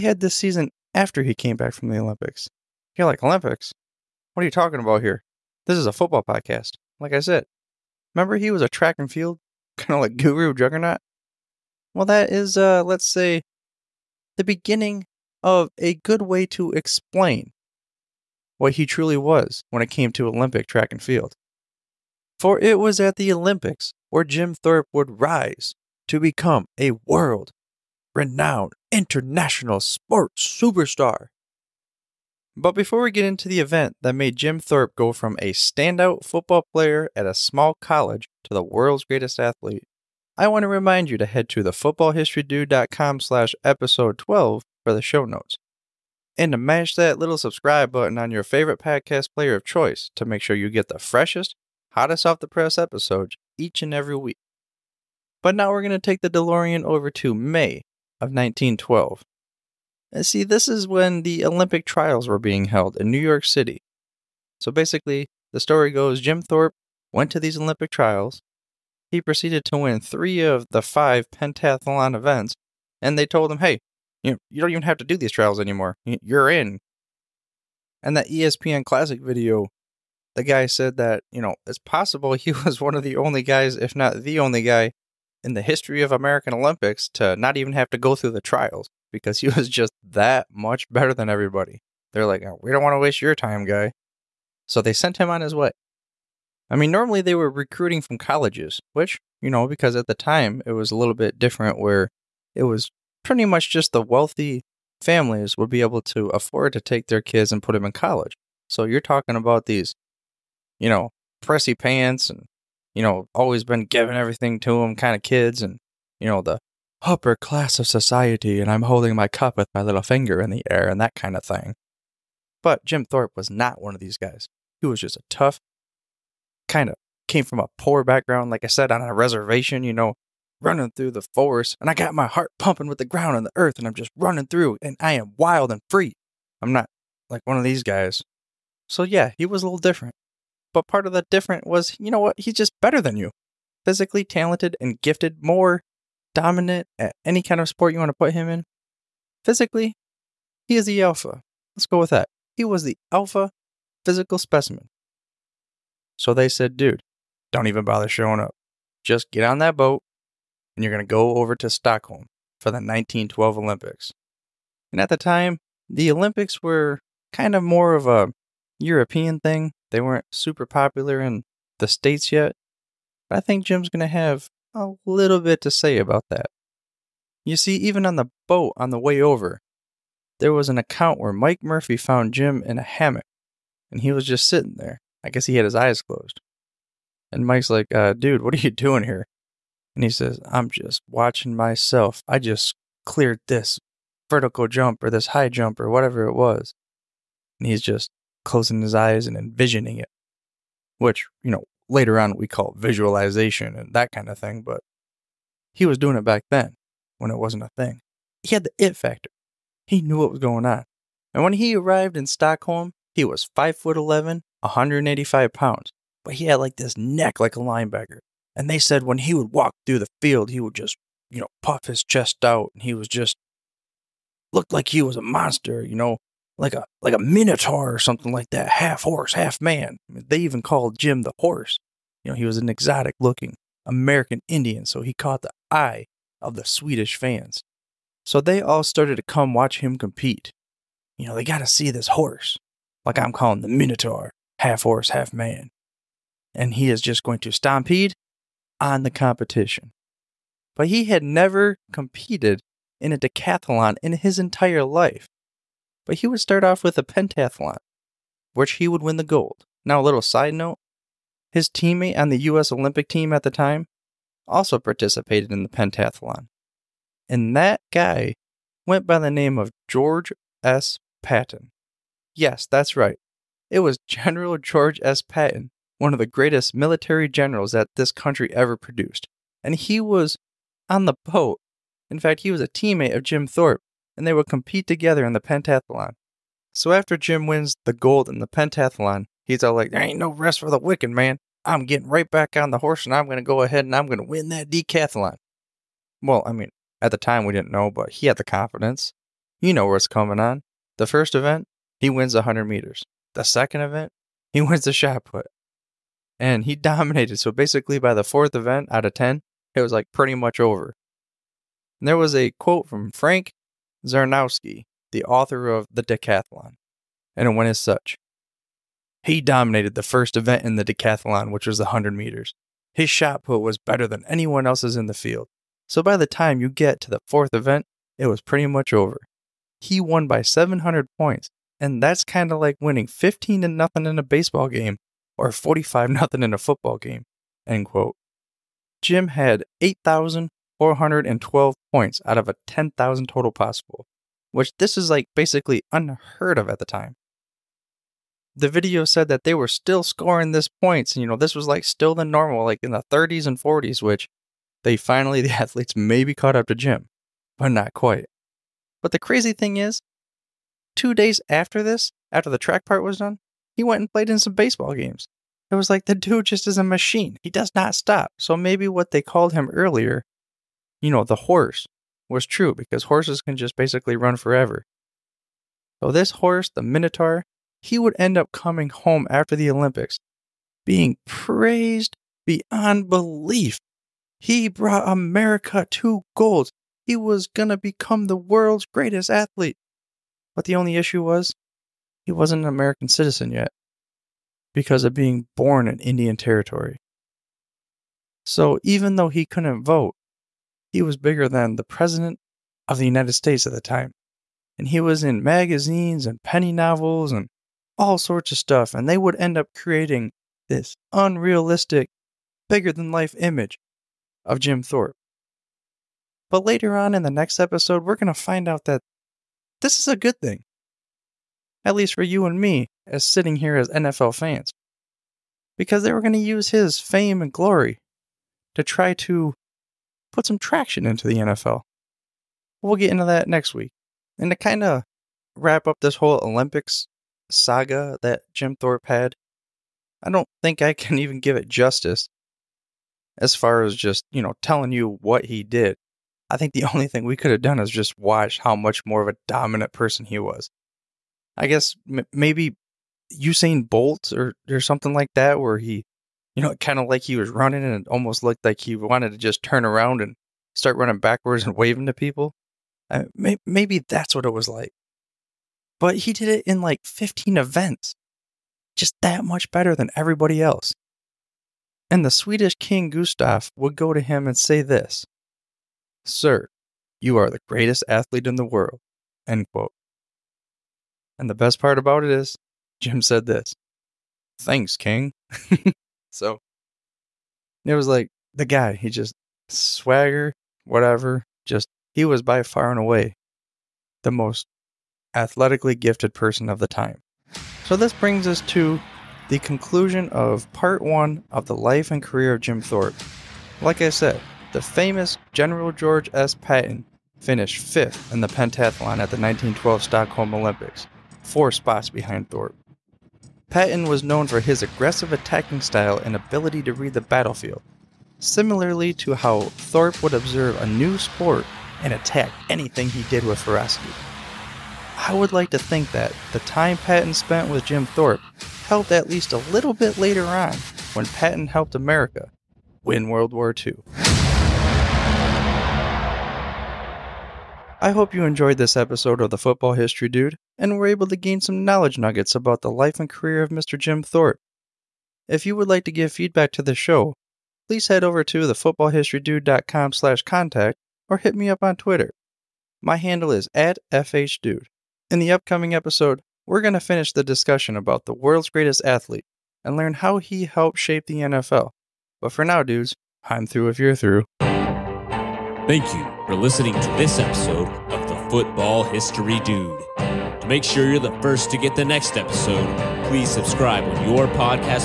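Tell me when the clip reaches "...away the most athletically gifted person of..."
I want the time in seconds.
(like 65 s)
492 s.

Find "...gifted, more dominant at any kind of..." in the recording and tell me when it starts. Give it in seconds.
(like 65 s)
145 s.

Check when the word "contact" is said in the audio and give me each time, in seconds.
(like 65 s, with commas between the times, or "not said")
550 s.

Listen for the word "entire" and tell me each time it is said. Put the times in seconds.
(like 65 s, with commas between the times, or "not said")
254 s.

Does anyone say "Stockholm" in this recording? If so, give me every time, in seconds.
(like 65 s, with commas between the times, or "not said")
161 s, 212 s, 510 s.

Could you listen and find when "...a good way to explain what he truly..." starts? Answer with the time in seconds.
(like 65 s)
15 s.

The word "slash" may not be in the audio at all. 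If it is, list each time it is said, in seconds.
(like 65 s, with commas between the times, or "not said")
43 s, 550 s.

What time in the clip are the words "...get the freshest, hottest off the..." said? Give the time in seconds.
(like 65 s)
50 s.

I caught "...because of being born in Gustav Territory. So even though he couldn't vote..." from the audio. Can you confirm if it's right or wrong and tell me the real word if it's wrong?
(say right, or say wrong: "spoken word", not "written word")
wrong: "Indian", not "Gustav".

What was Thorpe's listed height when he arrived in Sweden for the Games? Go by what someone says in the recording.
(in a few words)
5 foot 11.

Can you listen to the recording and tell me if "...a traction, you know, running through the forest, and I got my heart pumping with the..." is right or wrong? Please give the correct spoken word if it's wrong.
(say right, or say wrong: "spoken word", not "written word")
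wrong: "reservation", not "traction".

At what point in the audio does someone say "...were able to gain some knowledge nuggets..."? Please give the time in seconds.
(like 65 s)
540 s.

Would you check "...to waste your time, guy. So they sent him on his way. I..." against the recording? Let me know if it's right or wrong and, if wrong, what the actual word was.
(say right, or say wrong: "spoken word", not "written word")
right.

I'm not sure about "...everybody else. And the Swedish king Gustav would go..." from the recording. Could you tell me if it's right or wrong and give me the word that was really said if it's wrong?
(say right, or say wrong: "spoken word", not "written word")
right.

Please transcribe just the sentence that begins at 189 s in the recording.
And he says, I'm just watching myself.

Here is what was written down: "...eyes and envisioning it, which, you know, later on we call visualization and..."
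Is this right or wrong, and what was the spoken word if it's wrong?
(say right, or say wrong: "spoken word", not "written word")
right.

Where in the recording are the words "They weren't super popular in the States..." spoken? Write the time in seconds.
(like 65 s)
169 s.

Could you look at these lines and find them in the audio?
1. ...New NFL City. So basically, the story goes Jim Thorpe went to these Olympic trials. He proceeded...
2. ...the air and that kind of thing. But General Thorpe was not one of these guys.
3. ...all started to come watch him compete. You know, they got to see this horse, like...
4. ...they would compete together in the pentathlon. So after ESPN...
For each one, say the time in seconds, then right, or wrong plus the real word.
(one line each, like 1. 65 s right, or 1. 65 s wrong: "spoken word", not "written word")
1. 63 s wrong: "York", not "NFL"
2. 120 s wrong: "Jim", not "General"
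3. 238 s right
4. 284 s wrong: "Jim", not "ESPN".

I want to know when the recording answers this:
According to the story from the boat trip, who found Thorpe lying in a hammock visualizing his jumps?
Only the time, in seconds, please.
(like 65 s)
181 s.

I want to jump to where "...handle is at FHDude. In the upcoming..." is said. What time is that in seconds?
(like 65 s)
553 s.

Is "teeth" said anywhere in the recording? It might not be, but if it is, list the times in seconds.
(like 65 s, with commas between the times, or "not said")
not said.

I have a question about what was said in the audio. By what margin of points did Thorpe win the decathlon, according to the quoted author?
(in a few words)
700 points.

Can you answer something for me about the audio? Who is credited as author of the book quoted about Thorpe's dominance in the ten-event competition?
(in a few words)
Frank Zarnowski.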